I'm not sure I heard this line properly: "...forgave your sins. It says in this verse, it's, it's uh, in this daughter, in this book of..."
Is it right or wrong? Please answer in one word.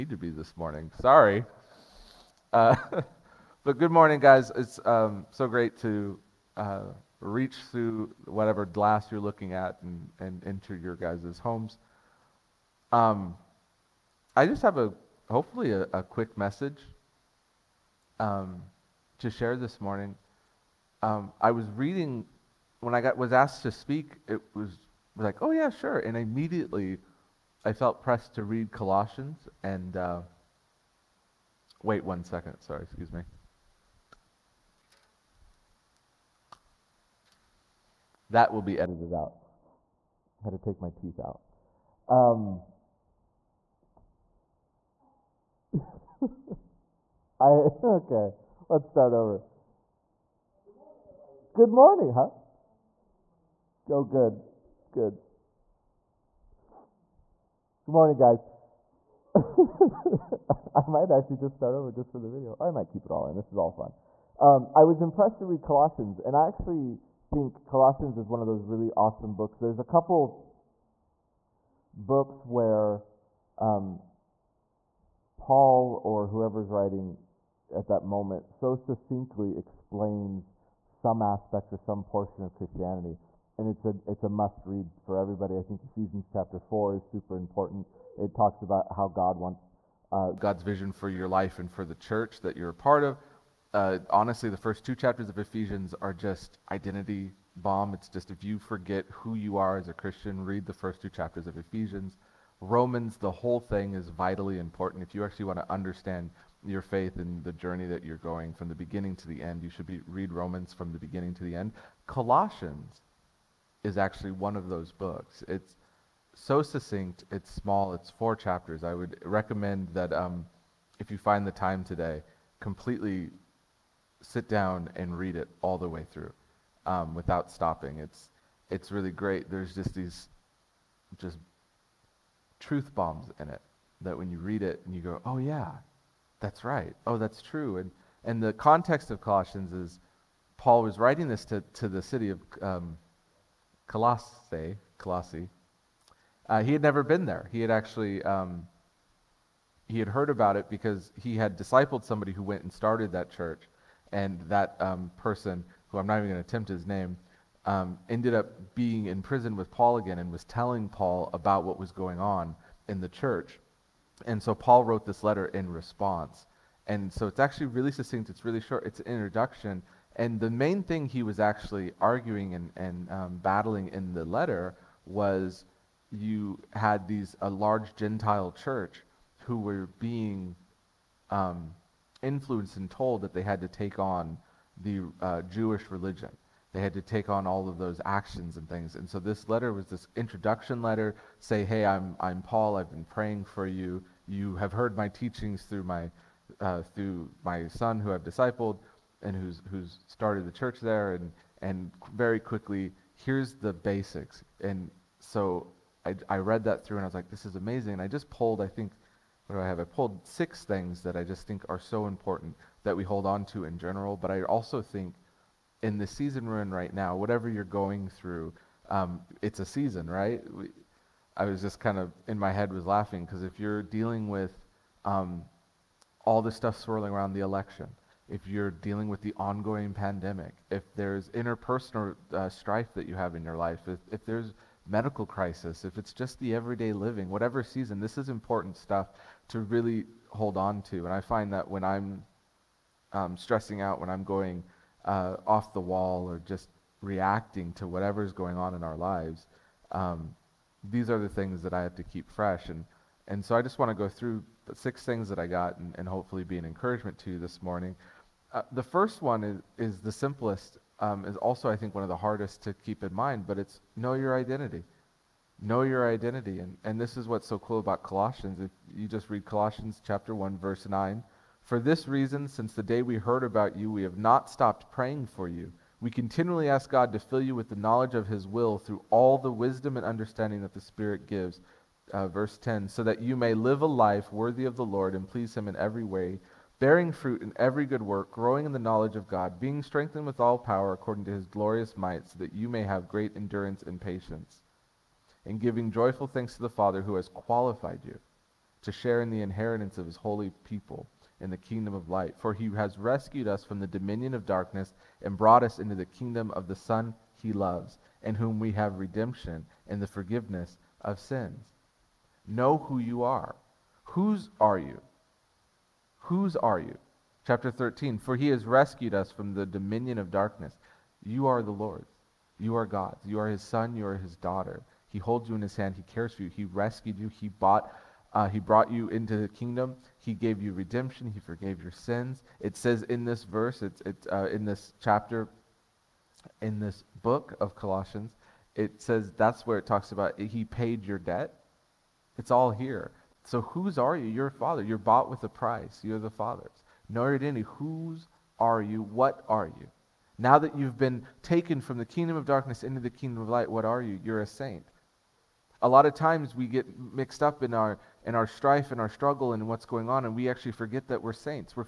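wrong.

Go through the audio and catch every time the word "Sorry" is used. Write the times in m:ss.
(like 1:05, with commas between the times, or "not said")
0:00, 0:32.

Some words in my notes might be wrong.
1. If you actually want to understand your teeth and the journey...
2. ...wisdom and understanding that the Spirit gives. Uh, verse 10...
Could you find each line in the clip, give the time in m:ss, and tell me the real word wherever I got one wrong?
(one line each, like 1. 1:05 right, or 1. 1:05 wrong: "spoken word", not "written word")
1. 1:45 wrong: "faith", not "teeth"
2. 4:39 right.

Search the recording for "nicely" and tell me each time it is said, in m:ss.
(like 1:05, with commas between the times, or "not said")
not said.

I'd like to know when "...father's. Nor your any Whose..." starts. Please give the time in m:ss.
5:46.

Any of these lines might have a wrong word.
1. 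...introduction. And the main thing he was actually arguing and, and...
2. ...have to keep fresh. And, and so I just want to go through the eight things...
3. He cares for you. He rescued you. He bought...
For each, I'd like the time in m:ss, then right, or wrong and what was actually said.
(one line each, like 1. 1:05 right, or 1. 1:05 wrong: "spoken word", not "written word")
1. 2:49 right
2. 4:11 wrong: "six", not "eight"
3. 5:25 right.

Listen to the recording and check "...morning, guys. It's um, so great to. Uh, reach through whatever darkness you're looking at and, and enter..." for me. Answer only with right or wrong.
wrong.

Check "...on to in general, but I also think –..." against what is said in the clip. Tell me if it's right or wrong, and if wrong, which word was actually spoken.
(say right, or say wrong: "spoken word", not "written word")
right.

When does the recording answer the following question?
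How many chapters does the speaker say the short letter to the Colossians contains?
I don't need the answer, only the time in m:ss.
1:58.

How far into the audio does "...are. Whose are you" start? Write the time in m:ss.
5:13.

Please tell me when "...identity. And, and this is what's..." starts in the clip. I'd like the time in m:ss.
4:26.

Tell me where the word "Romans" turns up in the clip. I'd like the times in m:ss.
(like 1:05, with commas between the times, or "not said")
1:42, 1:50.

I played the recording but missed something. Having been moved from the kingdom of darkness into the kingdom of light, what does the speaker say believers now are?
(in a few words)
A saint.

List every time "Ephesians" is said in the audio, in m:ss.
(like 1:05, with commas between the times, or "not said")
1:25, 1:35, 1:41.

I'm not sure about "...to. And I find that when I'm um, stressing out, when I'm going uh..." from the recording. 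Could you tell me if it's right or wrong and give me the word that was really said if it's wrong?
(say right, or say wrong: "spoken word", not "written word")
right.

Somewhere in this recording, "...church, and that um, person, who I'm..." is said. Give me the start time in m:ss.
2:33.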